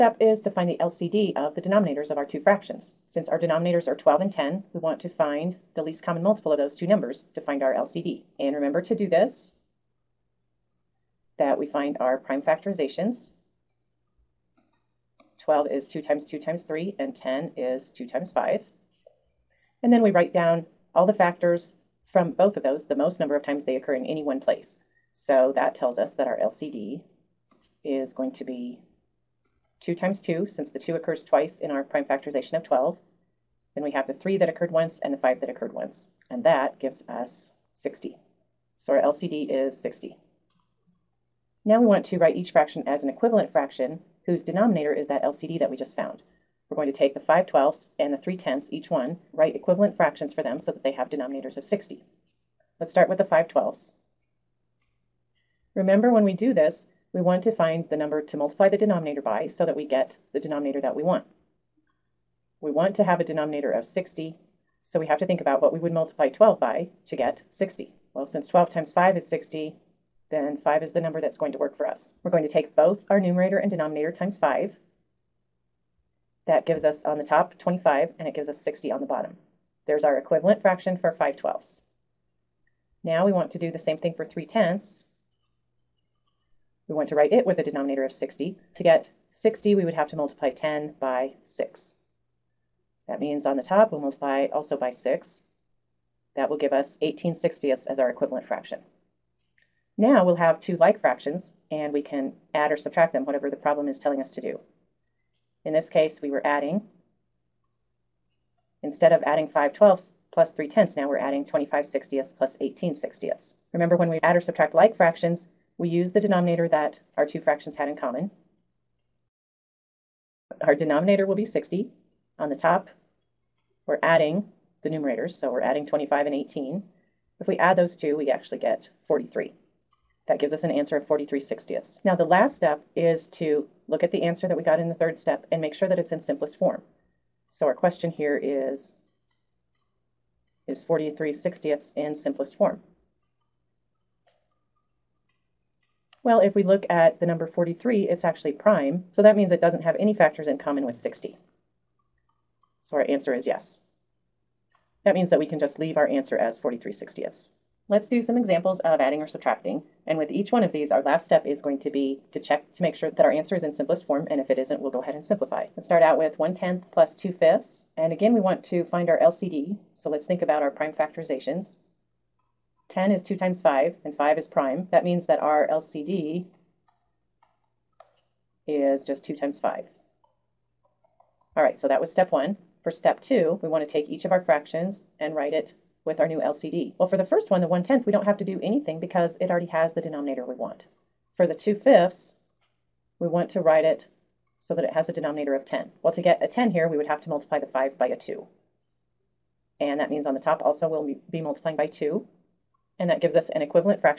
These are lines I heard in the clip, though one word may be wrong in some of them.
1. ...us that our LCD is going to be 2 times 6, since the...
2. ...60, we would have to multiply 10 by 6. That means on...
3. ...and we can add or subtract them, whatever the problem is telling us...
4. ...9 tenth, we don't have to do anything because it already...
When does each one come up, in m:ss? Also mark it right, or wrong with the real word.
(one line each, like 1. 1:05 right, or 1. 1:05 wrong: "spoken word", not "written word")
1. 0:25 wrong: "2", not "6"
2. 1:29 right
3. 1:41 right
4. 3:07 wrong: "1", not "9".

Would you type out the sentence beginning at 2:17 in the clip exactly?
So our question here is, is 43 sixtieths in simplest form?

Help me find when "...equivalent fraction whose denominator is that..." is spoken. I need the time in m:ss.
0:43.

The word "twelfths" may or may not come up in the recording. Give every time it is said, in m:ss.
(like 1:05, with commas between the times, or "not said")
0:47, 0:53, 1:21, 1:49.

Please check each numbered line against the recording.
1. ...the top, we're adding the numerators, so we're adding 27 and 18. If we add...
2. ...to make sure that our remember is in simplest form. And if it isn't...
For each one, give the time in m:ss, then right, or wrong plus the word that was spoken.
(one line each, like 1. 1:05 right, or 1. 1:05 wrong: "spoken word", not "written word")
1. 2:02 wrong: "25", not "27"
2. 2:42 wrong: "answer", not "remember".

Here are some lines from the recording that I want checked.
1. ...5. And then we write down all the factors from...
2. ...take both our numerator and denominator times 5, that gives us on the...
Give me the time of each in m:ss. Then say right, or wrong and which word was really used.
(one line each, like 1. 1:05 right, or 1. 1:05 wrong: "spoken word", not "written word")
1. 0:18 right
2. 1:12 right.